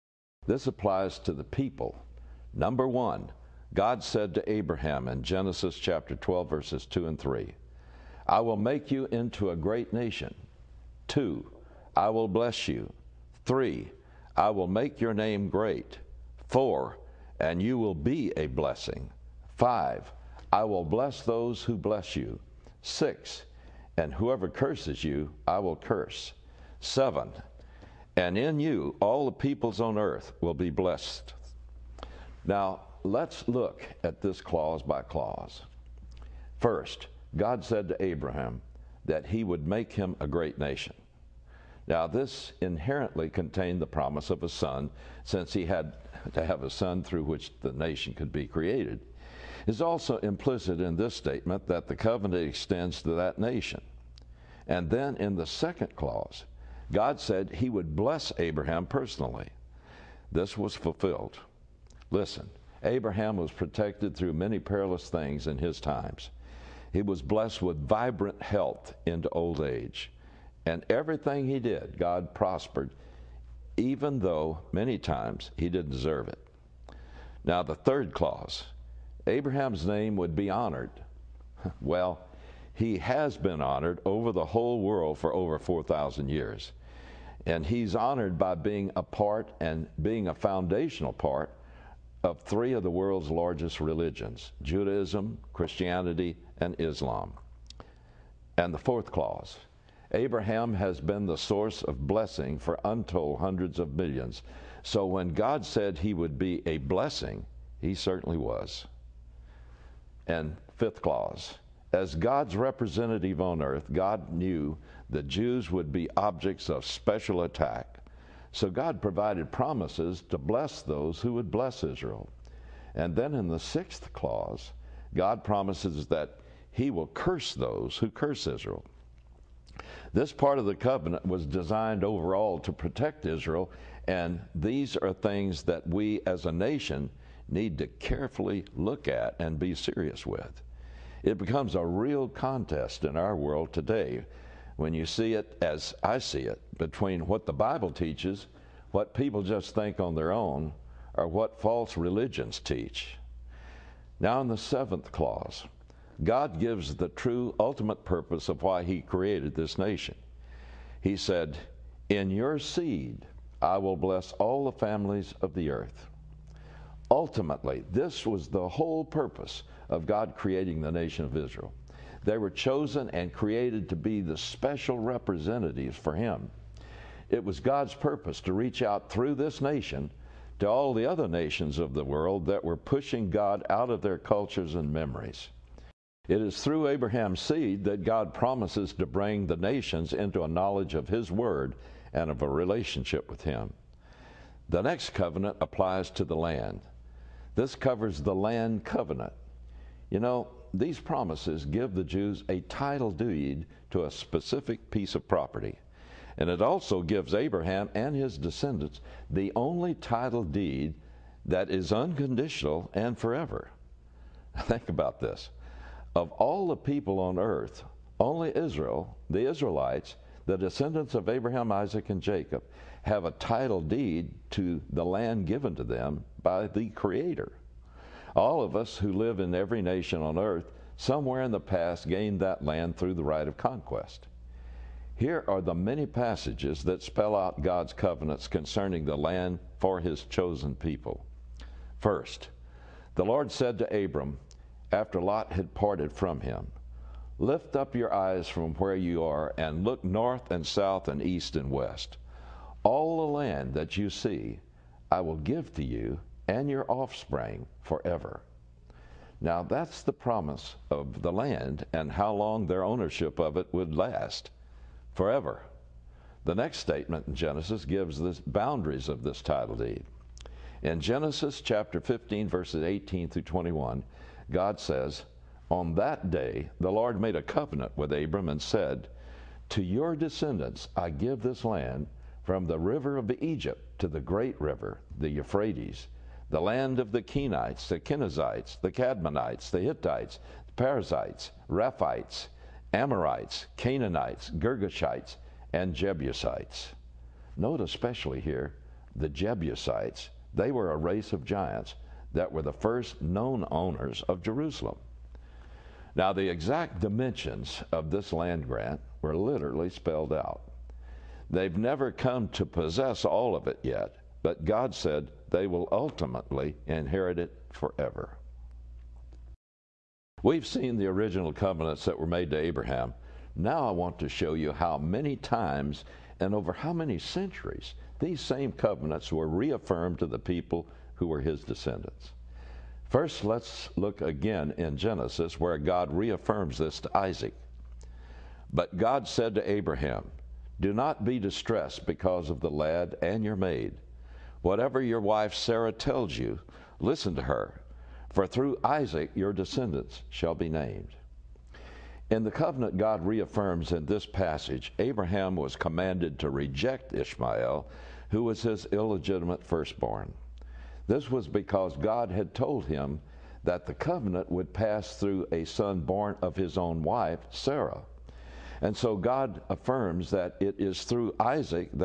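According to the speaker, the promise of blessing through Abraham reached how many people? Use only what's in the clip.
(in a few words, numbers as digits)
untold hundreds of millions.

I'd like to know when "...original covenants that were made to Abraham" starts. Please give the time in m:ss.
5:21.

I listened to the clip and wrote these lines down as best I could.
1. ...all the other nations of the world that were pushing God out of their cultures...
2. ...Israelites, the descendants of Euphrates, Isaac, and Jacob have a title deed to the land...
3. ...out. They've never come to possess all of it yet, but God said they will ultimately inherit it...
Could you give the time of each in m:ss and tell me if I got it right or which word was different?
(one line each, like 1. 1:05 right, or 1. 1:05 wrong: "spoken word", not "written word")
1. 3:00 right
2. 3:39 wrong: "Abraham", not "Euphrates"
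3. 5:10 right.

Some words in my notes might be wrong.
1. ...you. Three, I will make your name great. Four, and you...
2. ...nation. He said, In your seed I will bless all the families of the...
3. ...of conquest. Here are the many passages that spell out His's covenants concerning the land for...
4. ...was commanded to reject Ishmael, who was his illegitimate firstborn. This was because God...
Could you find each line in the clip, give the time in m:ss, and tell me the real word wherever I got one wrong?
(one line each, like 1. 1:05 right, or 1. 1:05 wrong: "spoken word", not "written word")
1. 0:12 right
2. 2:39 right
3. 3:53 wrong: "God", not "His"
4. 5:55 right.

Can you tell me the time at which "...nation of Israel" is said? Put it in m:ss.
2:50.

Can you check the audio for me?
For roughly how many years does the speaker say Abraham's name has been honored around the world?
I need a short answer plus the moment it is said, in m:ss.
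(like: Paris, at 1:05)
over 4,000 years, at 1:25.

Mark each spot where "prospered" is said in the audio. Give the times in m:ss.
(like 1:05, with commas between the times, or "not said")
1:12.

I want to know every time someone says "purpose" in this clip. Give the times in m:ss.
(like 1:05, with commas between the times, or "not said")
2:38, 2:49, 2:57.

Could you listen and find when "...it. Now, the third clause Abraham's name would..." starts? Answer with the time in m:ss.
1:16.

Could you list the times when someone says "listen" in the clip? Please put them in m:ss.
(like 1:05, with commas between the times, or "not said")
1:02, 5:46.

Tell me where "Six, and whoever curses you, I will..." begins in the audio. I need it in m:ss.
0:22.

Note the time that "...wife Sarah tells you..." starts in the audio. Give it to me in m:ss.
5:45.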